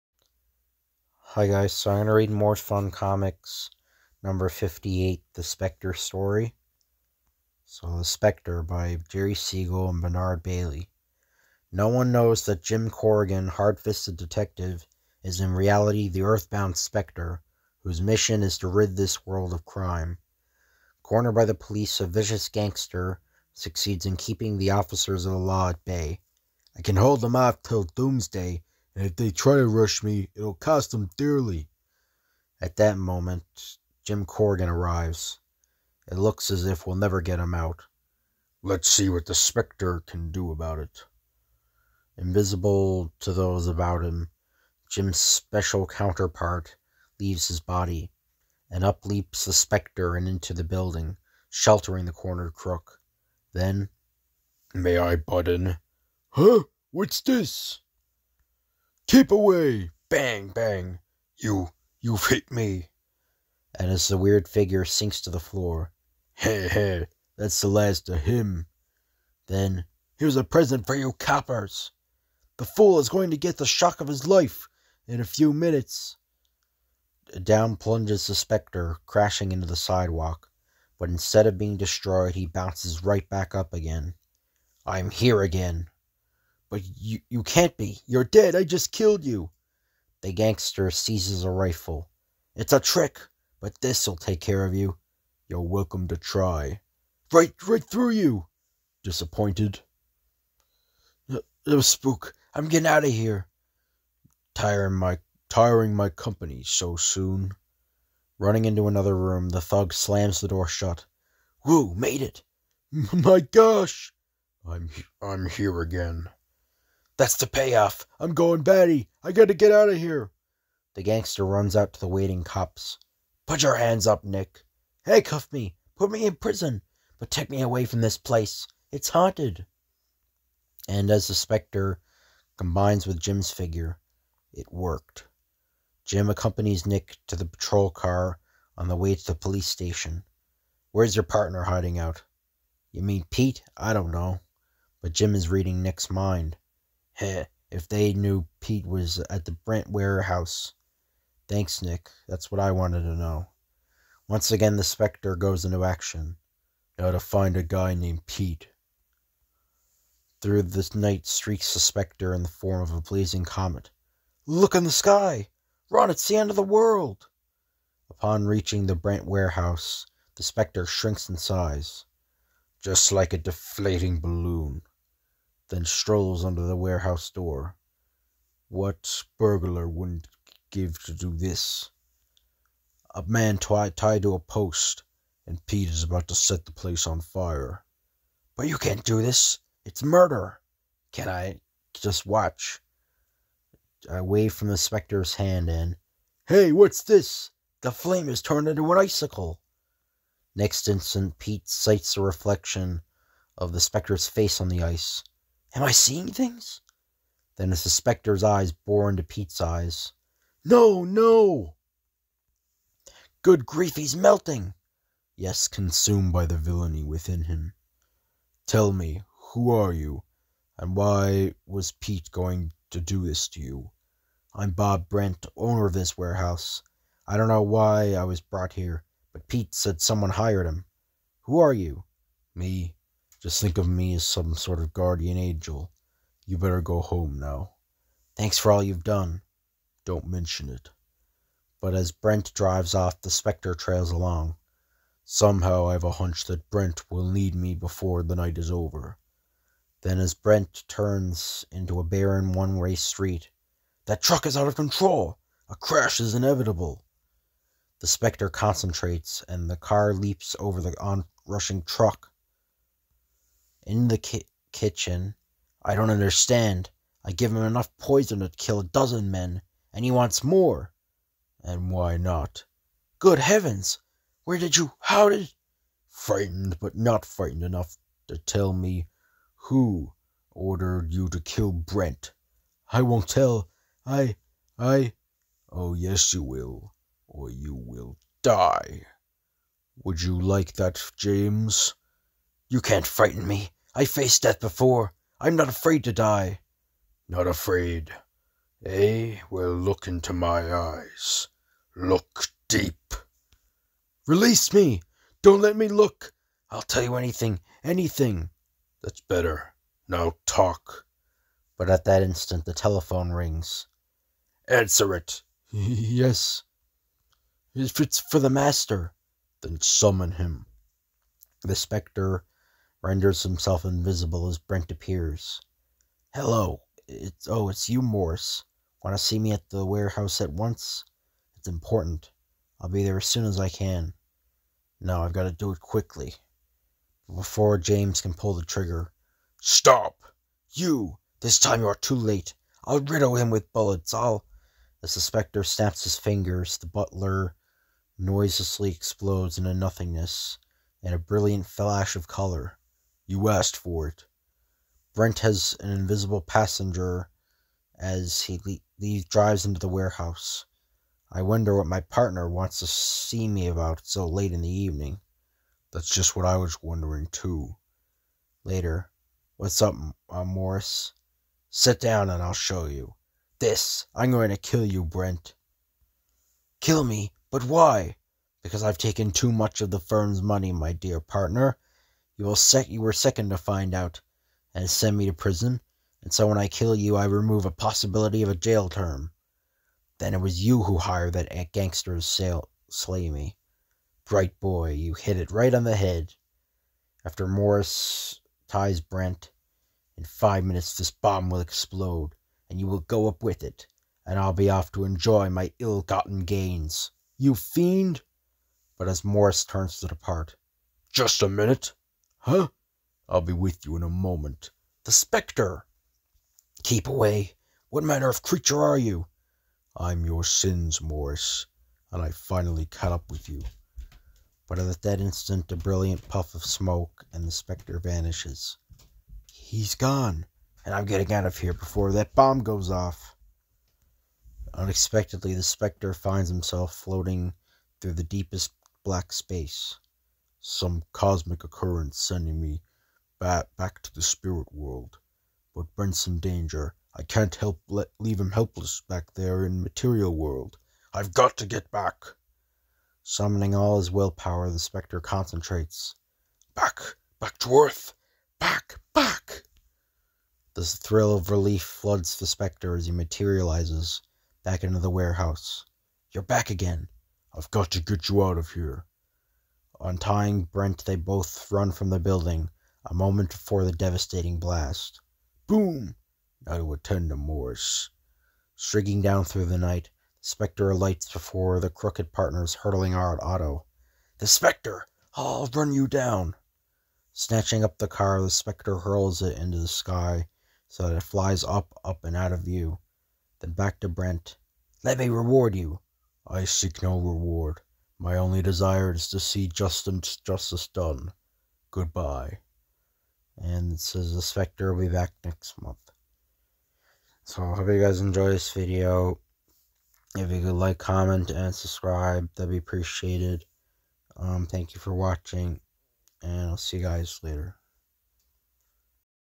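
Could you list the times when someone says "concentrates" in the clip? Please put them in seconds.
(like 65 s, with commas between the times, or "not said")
258 s, 455 s.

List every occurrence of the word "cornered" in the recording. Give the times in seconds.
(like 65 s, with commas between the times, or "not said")
21 s, 52 s.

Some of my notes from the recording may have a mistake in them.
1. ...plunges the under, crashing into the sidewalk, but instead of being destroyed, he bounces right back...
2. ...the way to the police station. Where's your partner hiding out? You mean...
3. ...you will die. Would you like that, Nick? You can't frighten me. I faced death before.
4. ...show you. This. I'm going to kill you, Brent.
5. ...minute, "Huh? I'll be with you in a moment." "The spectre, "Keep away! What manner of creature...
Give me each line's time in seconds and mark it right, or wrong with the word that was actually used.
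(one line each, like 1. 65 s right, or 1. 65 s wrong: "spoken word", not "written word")
1. 77 s wrong: "specter", not "under"
2. 138 s right
3. 287 s wrong: "James", not "Nick"
4. 372 s right
5. 411 s right.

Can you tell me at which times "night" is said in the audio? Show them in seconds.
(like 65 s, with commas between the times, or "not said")
160 s, 248 s, 479 s.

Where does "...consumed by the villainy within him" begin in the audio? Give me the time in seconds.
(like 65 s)
215 s.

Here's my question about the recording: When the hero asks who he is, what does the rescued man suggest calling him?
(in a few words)
Guardian angel.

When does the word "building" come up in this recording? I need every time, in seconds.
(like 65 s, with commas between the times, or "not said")
50 s, 472 s.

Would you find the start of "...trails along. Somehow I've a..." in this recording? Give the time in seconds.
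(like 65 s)
243 s.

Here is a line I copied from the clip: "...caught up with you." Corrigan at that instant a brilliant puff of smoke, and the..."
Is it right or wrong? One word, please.
wrong.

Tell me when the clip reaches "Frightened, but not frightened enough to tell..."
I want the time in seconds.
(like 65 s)
276 s.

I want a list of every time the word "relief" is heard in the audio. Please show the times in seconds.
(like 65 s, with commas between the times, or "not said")
461 s.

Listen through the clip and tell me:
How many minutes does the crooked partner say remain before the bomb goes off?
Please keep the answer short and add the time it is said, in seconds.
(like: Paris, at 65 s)
5, at 400 s.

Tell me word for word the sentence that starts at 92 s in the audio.
It's a trick, but this'll take care of you.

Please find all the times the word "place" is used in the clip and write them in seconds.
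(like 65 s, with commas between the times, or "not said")
128 s, 186 s.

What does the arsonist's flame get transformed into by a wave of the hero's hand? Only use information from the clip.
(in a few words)
An icicle.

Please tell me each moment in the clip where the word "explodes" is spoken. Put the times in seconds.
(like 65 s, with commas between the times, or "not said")
348 s, 401 s.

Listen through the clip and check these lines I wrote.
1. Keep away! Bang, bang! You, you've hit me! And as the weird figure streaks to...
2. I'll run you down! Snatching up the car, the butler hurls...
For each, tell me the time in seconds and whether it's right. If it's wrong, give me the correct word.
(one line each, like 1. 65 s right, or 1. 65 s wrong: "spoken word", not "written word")
1. 59 s wrong: "sinks", not "streaks"
2. 485 s wrong: "specter", not "butler".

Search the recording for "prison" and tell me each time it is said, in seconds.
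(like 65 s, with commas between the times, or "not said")
126 s, 385 s.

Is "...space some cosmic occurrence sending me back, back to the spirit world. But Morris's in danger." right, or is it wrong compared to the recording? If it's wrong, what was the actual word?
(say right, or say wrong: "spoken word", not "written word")
wrong: "Brent", not "Morris".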